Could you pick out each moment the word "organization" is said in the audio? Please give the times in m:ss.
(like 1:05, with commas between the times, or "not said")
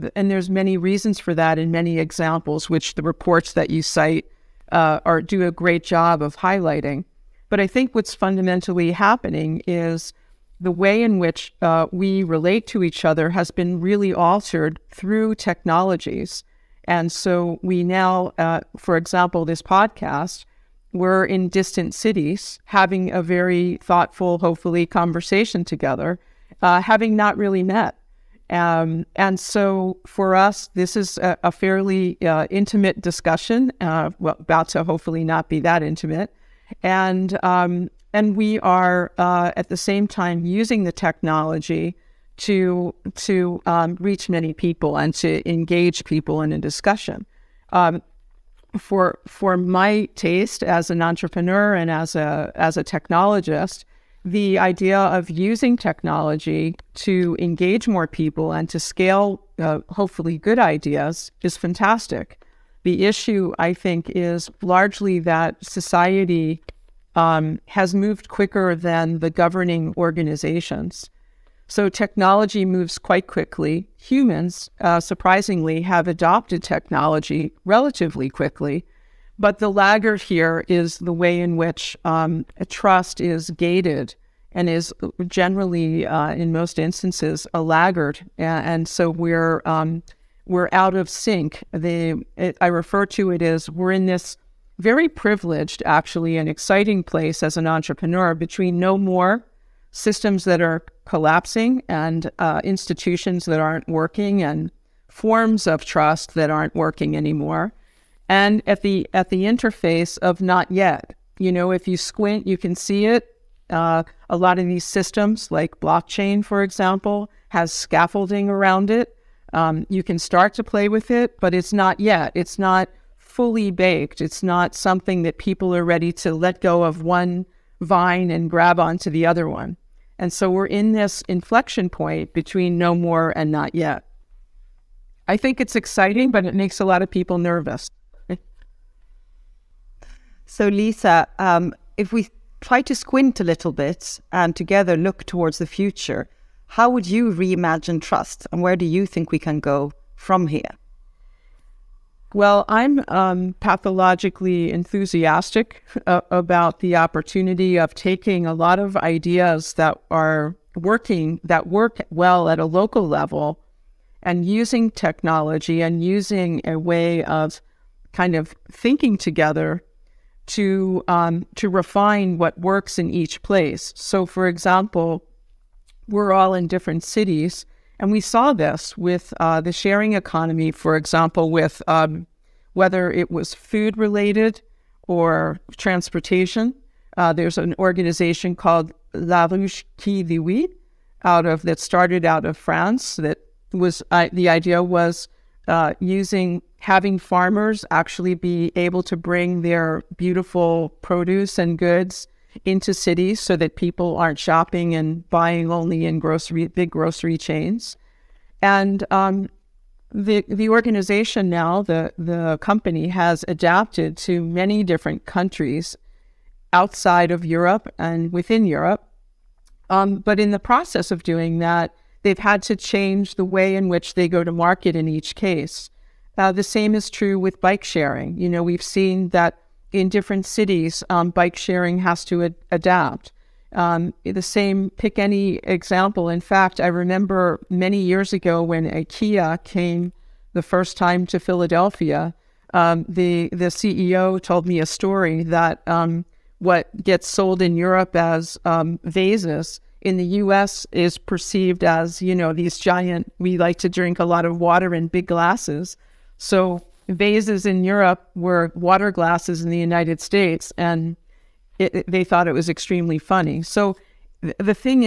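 1:09, 3:07, 3:30.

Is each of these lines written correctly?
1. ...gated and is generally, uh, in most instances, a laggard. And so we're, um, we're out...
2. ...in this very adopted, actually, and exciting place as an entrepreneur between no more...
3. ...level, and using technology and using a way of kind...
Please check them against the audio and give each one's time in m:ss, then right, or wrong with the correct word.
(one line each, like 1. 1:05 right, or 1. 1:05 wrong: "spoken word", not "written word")
1. 1:23 right
2. 1:33 wrong: "privileged", not "adopted"
3. 2:43 right.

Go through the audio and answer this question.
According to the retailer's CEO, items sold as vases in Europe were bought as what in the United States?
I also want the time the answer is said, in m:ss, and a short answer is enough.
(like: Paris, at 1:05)
water glasses, at 4:18.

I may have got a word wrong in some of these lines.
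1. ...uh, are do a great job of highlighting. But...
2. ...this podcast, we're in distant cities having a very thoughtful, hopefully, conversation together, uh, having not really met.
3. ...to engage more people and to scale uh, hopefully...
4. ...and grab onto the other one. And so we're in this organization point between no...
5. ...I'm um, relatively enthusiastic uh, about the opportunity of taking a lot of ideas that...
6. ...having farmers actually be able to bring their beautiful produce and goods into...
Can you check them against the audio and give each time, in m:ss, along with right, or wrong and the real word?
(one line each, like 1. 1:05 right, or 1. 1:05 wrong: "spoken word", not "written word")
1. 0:04 right
2. 0:19 right
3. 0:56 right
4. 2:08 wrong: "inflection", not "organization"
5. 2:32 wrong: "pathologically", not "relatively"
6. 3:16 right.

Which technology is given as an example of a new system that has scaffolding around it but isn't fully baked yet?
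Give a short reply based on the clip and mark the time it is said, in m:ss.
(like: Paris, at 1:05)
blockchain, at 1:55.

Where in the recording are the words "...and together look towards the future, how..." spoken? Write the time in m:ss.
2:24.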